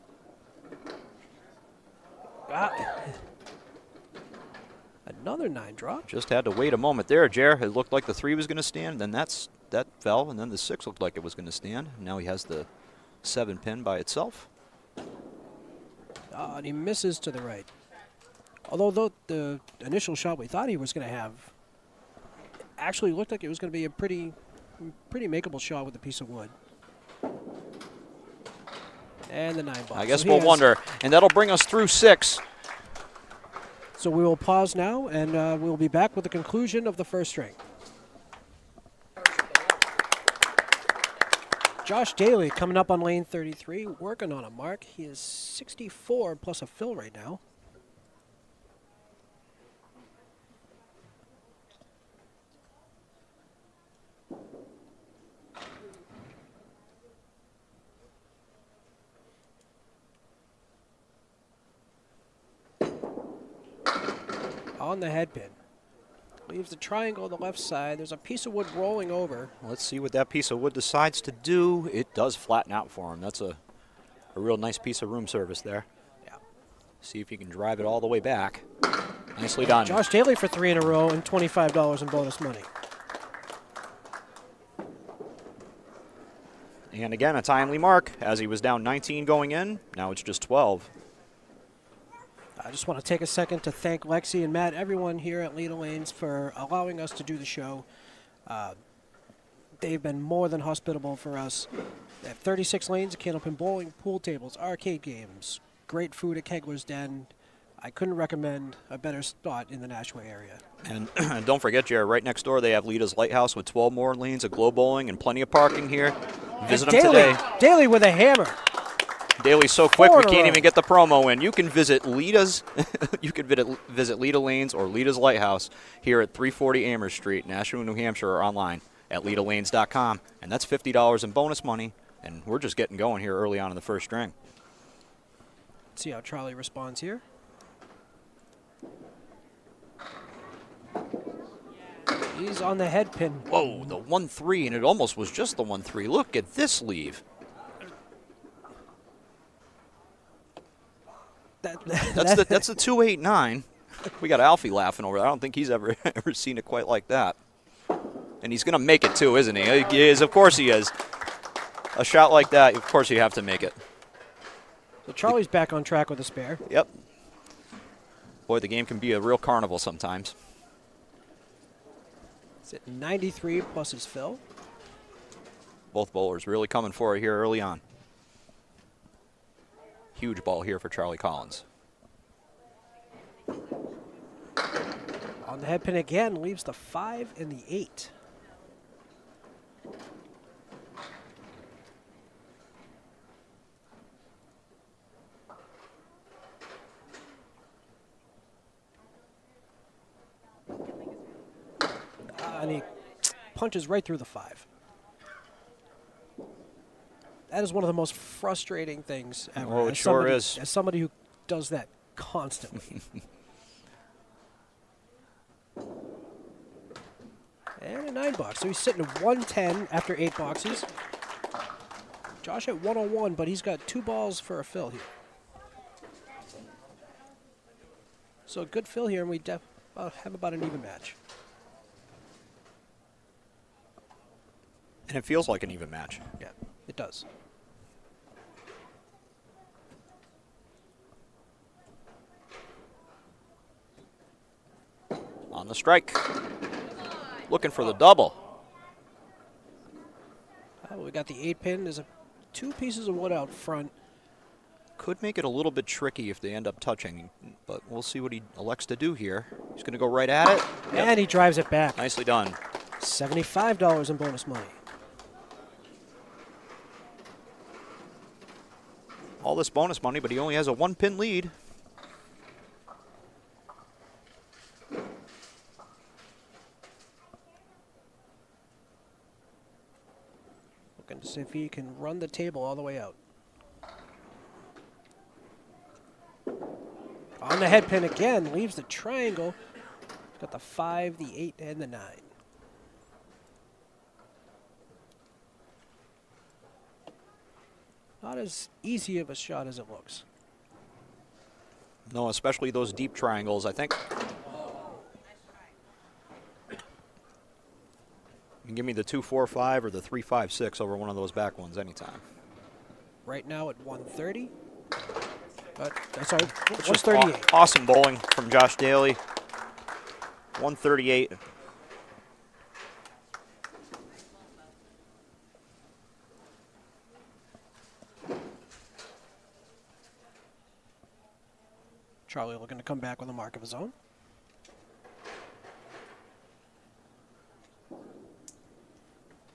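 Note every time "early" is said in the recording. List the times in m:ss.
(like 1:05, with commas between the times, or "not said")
2:13, 2:57.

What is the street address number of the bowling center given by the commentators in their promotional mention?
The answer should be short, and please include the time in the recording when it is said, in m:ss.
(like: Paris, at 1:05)
340, at 2:06.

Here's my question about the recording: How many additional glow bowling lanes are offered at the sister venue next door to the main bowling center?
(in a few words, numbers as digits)
12.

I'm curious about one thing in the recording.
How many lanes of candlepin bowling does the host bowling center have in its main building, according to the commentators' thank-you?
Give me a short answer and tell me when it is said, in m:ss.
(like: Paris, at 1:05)
36, at 1:42.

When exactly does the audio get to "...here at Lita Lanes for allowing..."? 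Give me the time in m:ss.
1:35.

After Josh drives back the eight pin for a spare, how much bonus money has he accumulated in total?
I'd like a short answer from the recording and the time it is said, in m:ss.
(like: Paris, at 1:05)
$75, at 4:23.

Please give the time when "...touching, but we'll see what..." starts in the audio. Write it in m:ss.
4:16.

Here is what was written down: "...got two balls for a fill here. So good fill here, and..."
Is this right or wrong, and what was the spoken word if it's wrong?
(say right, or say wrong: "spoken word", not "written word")
right.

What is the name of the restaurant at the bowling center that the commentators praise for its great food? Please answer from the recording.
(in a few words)
Kegler's Den.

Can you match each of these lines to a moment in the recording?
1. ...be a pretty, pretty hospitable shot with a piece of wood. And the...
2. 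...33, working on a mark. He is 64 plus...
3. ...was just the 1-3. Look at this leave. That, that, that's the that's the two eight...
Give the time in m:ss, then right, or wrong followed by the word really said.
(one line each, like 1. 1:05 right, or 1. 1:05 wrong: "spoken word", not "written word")
1. 0:23 wrong: "makeable", not "hospitable"
2. 0:43 right
3. 2:25 right.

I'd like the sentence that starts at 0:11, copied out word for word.
Now he has the seven pin by itself.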